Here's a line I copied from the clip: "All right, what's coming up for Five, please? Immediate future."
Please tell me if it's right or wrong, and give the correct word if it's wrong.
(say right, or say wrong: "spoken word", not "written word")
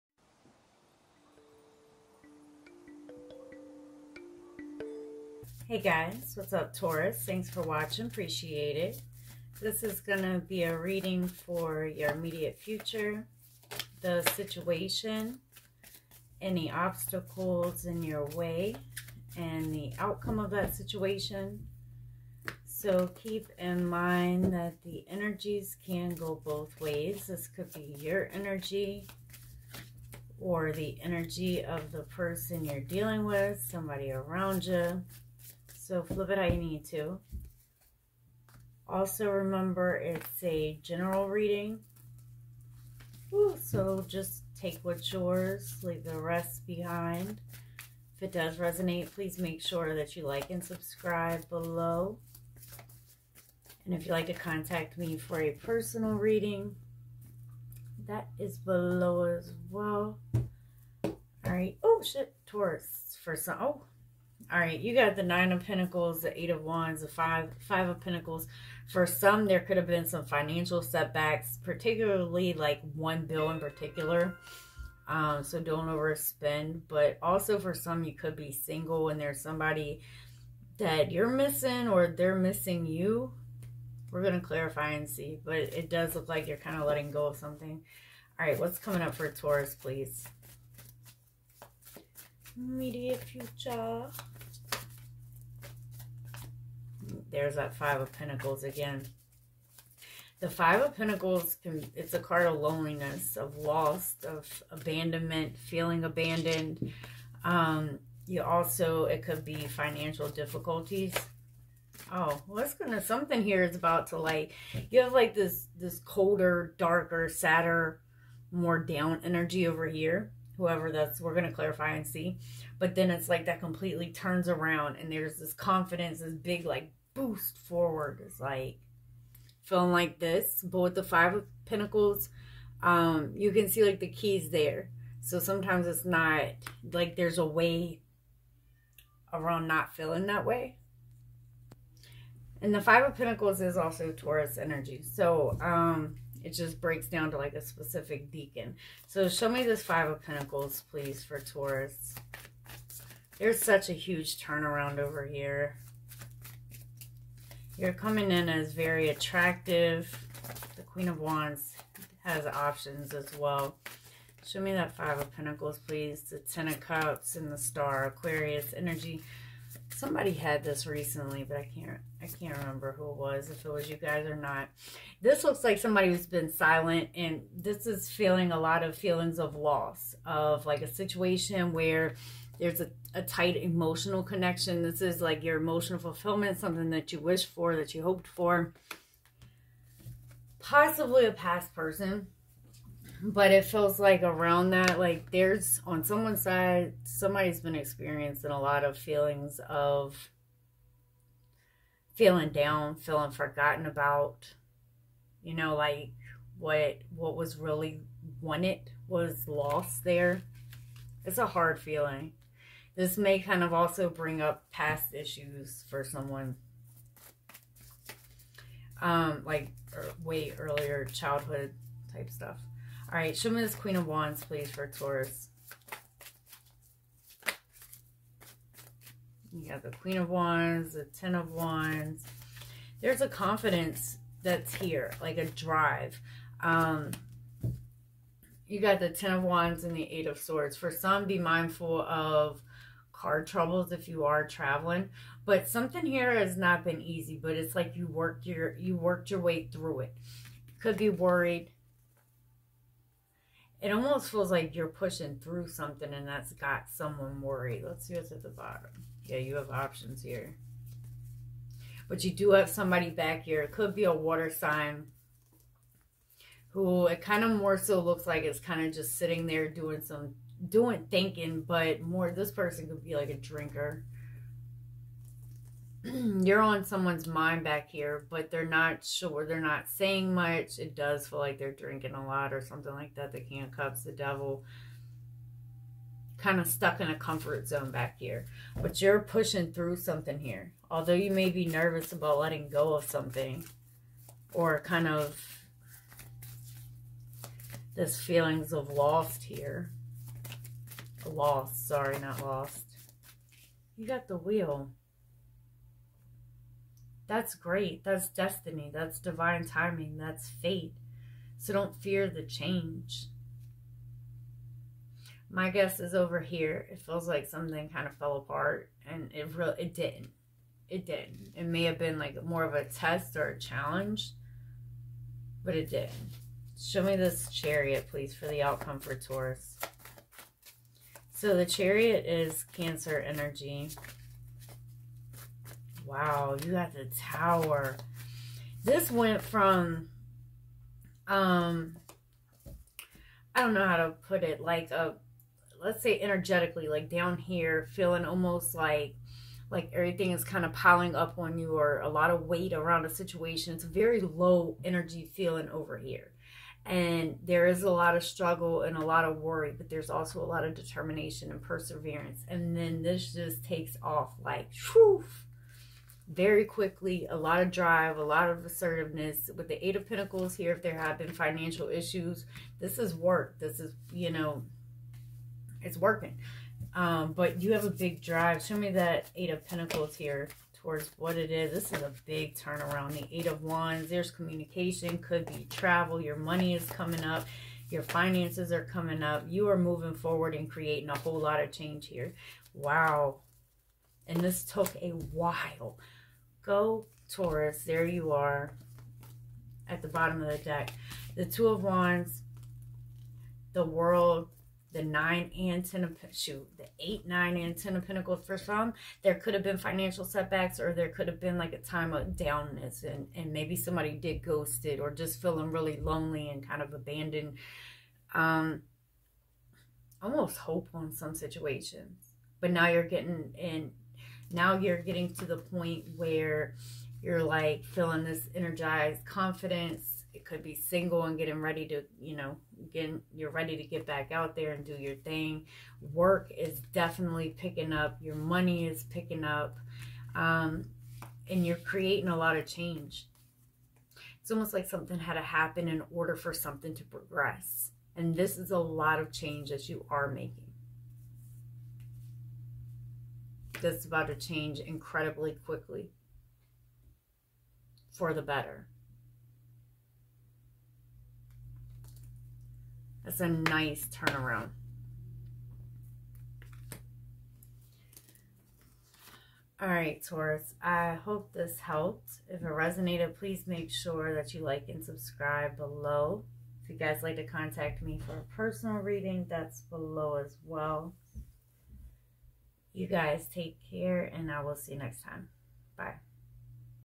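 wrong: "Taurus", not "Five".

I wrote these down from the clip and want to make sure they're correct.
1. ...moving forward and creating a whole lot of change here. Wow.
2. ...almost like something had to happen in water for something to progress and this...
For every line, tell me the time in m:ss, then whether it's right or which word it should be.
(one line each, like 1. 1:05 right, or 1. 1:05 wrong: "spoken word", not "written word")
1. 6:29 right
2. 7:24 wrong: "order", not "water".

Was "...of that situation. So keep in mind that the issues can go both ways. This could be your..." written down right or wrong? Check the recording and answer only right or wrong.
wrong.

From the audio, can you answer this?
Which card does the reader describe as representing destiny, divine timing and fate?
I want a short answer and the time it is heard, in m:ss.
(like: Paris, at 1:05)
The Wheel, at 5:04.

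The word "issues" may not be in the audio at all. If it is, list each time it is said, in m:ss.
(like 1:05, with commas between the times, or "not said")
3:35, 6:11.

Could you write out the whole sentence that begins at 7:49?
All right, Taurus, I hope this helped.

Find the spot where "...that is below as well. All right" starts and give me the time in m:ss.
0:58.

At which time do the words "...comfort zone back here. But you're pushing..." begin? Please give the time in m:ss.
4:47.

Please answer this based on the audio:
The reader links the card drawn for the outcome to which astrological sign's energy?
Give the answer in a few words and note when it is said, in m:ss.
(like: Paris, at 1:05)
Cancer, at 5:32.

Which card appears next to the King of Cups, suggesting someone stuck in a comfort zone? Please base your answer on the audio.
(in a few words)
The Devil.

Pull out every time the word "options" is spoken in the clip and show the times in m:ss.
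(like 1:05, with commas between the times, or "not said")
2:42, 4:19.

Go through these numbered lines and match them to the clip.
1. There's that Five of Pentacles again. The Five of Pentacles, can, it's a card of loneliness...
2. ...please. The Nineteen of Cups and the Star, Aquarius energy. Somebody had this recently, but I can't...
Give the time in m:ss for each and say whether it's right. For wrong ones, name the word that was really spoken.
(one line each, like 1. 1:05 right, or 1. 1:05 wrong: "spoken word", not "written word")
1. 1:37 right
2. 2:45 wrong: "Ten", not "Nineteen".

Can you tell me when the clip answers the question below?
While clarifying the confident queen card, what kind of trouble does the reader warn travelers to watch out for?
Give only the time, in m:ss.
4:03.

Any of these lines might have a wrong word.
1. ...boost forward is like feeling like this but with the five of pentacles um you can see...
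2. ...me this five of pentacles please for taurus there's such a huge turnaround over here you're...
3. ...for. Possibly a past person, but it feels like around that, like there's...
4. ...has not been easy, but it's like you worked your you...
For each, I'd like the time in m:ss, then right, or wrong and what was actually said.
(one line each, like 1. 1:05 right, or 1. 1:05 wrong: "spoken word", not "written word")
1. 2:07 right
2. 2:29 right
3. 3:08 right
4. 4:06 right.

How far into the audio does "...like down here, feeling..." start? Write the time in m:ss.
5:46.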